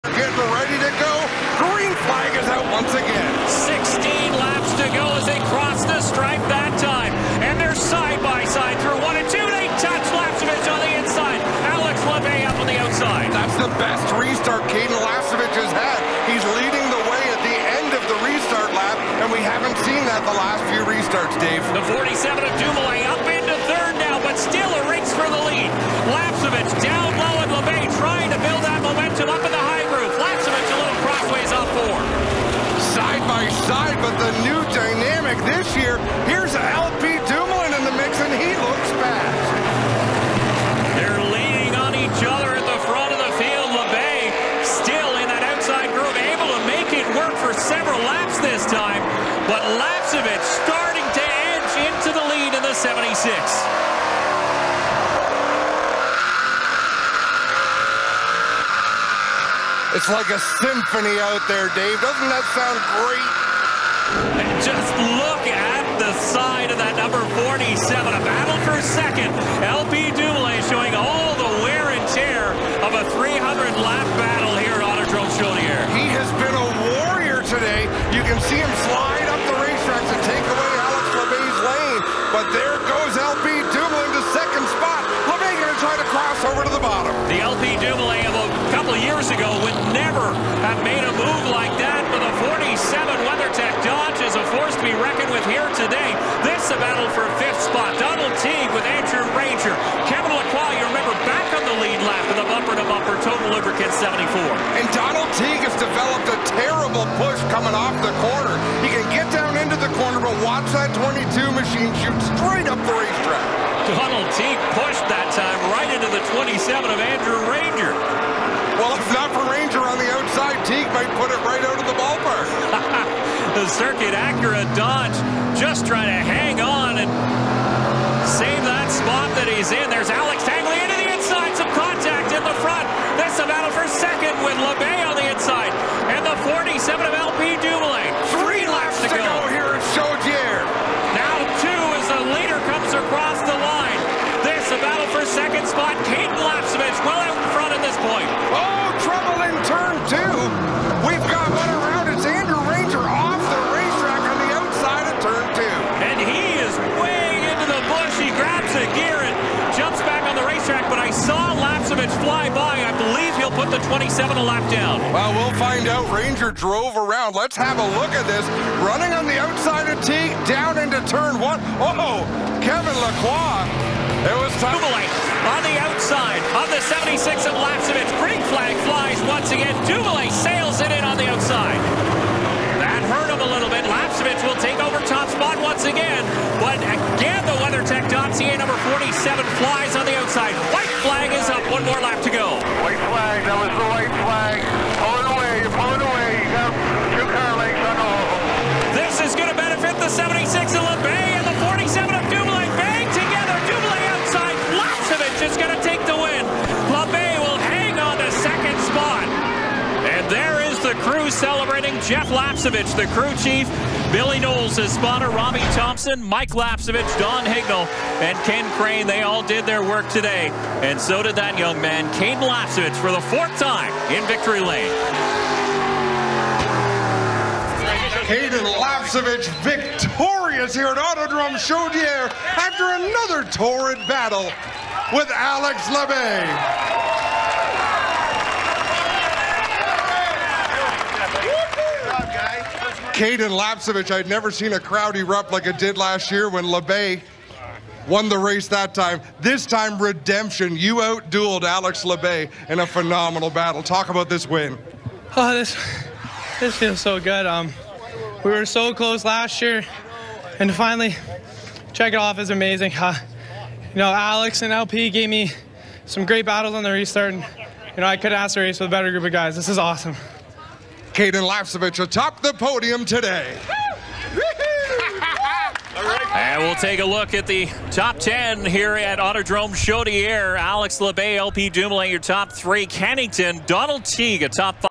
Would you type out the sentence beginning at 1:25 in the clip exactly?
Labbé going to try to cross over to the bottom.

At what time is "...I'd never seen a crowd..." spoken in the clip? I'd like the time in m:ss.
4:04.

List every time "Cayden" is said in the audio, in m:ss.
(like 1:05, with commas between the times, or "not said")
3:48, 4:03, 4:31.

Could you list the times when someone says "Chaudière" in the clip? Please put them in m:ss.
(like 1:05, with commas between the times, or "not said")
1:15, 3:51, 4:39.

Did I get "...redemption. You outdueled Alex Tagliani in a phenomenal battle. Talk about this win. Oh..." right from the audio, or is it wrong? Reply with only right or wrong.
wrong.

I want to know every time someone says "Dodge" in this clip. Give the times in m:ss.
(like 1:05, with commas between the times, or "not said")
1:33, 2:04.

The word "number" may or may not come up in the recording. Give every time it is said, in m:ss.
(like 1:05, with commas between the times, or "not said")
1:06, 3:08.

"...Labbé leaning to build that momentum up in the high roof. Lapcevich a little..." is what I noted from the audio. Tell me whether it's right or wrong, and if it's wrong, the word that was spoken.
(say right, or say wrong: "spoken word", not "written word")
wrong: "trying", not "leaning".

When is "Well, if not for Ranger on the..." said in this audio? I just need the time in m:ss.
1:58.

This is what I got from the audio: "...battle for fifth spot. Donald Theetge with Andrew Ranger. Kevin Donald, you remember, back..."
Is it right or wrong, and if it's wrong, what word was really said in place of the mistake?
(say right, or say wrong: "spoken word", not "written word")
wrong: "Lacroix", not "Donald".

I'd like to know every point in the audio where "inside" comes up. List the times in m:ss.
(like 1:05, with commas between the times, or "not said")
2:11, 2:15.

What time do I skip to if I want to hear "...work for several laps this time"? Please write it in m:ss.
0:47.